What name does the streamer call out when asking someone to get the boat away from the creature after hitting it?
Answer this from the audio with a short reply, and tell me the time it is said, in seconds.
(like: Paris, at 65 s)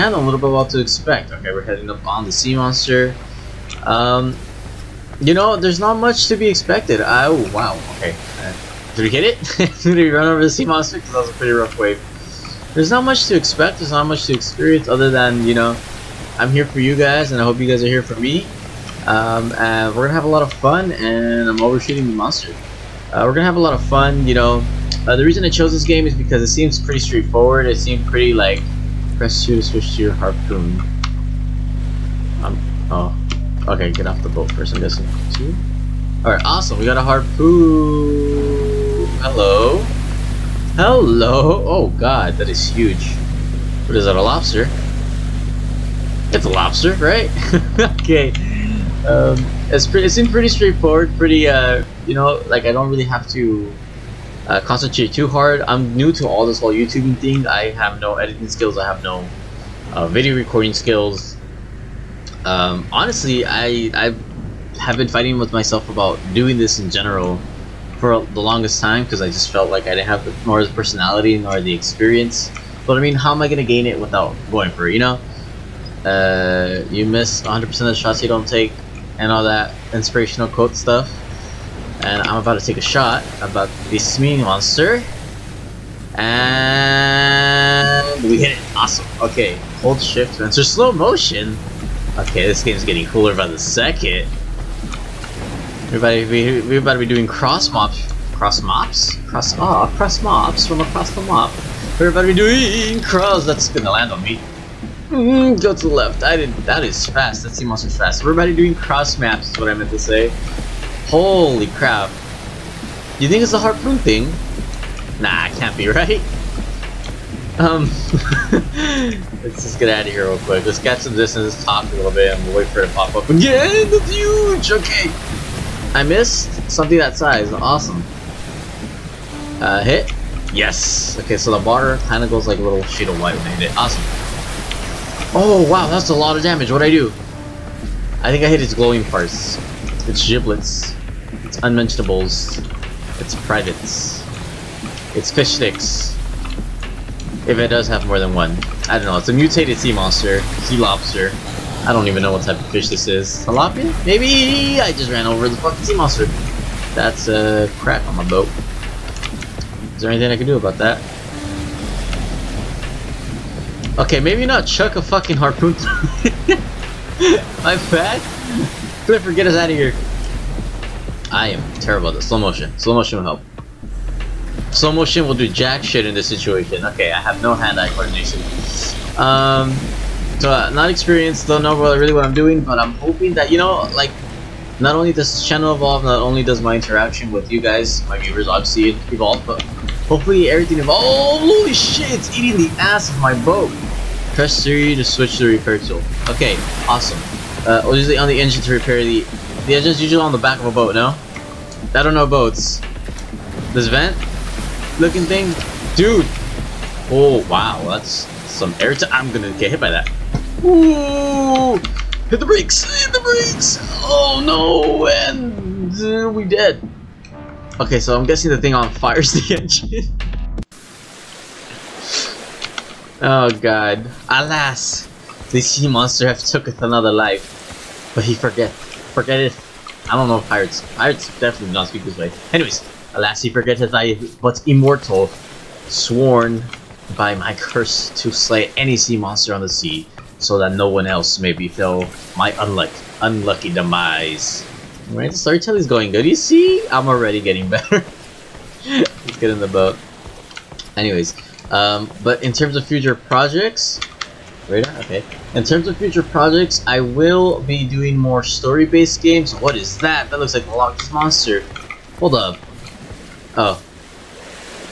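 Clifford, at 169 s.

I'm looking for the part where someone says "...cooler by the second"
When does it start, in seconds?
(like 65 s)
93 s.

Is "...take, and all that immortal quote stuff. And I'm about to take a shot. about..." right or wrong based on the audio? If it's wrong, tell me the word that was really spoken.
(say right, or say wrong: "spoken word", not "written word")
wrong: "inspirational", not "immortal".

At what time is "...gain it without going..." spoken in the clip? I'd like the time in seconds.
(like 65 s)
73 s.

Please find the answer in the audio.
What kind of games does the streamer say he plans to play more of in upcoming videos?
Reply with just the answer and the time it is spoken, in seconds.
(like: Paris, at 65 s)
Story-based games, at 258 s.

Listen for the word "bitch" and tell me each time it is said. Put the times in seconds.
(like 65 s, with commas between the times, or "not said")
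not said.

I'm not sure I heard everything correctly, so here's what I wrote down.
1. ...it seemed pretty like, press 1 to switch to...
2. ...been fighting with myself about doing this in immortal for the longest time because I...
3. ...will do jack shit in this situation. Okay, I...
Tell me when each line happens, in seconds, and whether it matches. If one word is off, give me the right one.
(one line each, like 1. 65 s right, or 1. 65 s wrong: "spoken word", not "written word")
1. 27 s wrong: "2", not "1"
2. 64 s wrong: "general", not "immortal"
3. 175 s right.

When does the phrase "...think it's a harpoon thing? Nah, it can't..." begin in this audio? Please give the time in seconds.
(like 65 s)
113 s.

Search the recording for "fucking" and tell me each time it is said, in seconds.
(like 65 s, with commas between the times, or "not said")
155 s, 165 s.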